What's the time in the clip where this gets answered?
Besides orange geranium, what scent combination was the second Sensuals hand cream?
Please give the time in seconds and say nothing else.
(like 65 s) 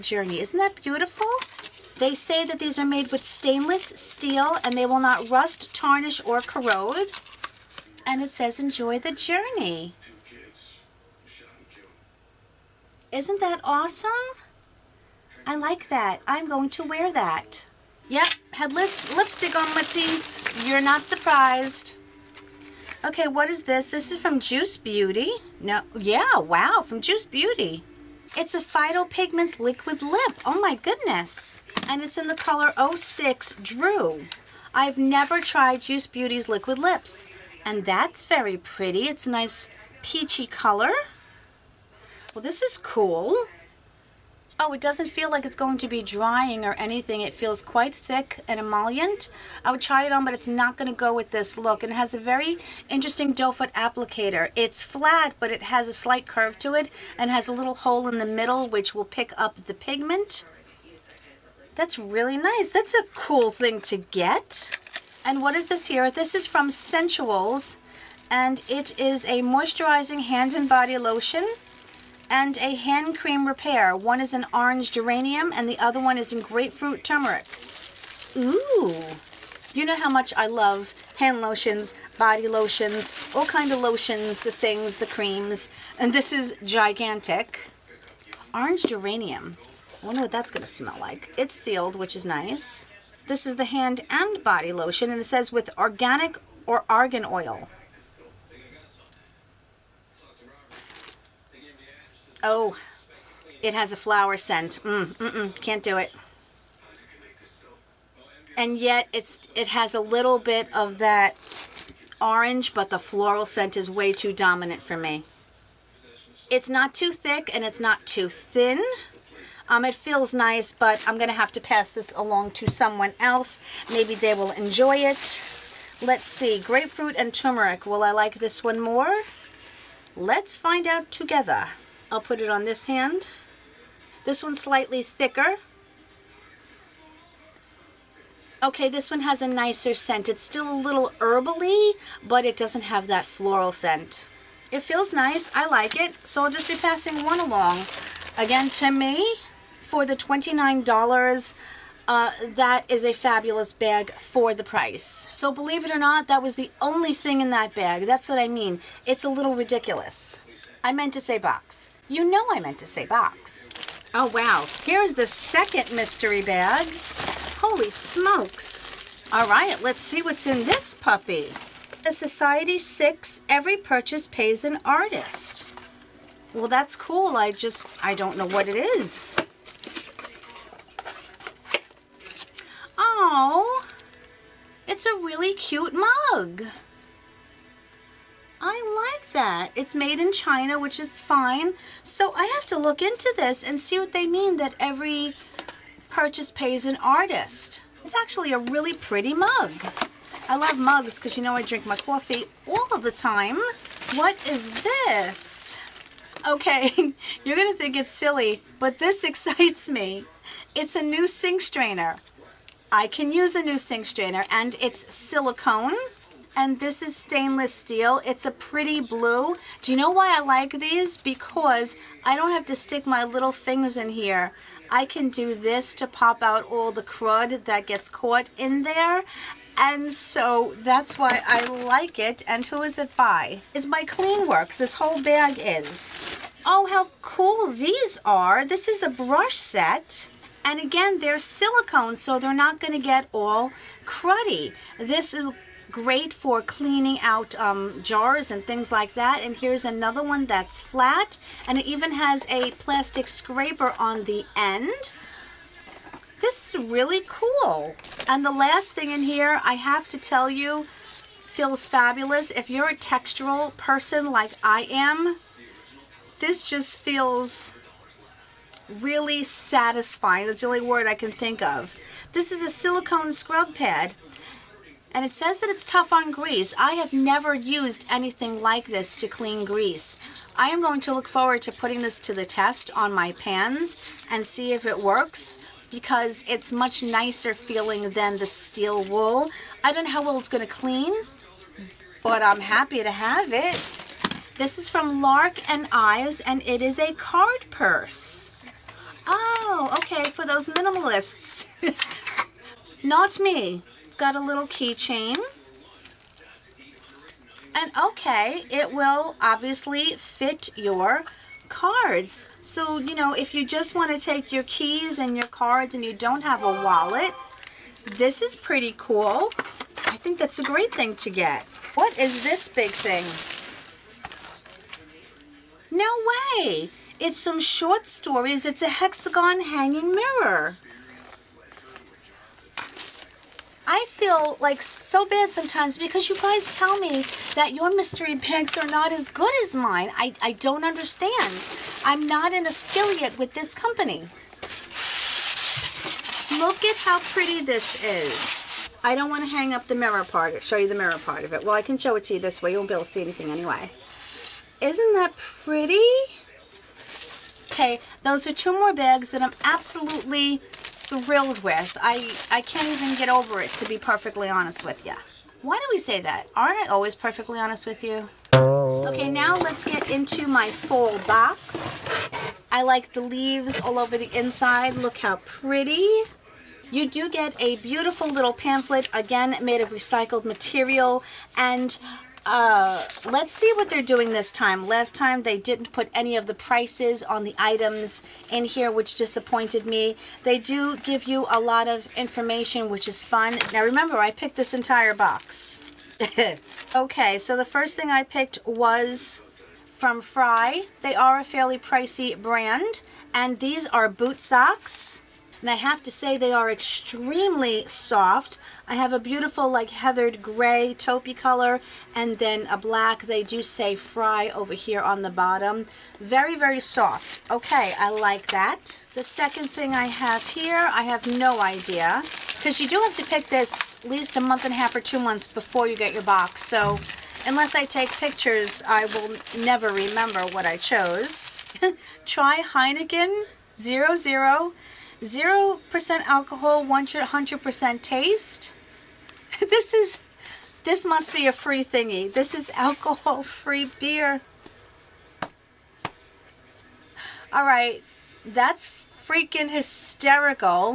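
76 s.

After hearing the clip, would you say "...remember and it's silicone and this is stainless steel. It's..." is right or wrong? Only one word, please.
wrong.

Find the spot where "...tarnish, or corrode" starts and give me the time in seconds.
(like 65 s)
5 s.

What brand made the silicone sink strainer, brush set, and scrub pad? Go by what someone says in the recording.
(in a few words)
My Clean Works.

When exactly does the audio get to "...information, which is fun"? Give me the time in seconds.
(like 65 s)
392 s.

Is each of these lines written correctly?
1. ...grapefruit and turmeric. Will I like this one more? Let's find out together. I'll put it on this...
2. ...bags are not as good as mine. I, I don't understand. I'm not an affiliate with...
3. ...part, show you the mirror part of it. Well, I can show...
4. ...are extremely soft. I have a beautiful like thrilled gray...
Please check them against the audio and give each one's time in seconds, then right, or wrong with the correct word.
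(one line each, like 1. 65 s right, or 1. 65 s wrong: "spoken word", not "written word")
1. 126 s right
2. 338 s right
3. 350 s right
4. 406 s wrong: "heathered", not "thrilled".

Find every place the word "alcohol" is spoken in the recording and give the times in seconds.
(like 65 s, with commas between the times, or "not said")
436 s, 442 s.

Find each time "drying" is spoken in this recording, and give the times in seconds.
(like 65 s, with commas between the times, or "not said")
46 s.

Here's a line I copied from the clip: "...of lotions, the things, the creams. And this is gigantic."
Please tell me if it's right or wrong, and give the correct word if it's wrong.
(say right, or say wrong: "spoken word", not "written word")
right.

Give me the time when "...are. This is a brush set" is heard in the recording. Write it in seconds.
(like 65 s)
238 s.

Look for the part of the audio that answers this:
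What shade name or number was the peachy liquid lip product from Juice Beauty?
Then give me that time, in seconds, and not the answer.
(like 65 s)
32 s.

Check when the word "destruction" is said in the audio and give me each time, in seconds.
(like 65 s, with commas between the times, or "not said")
not said.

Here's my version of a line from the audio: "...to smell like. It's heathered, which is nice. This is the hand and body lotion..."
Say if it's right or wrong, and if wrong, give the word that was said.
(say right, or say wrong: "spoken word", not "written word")
wrong: "sealed", not "heathered".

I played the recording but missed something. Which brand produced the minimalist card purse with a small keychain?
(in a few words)
Lark and Ives.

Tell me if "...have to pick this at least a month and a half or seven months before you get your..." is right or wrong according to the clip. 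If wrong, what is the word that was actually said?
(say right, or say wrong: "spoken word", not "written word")
wrong: "two", not "seven".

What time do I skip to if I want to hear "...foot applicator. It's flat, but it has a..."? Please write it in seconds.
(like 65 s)
53 s.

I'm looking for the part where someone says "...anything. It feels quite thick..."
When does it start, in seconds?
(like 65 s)
46 s.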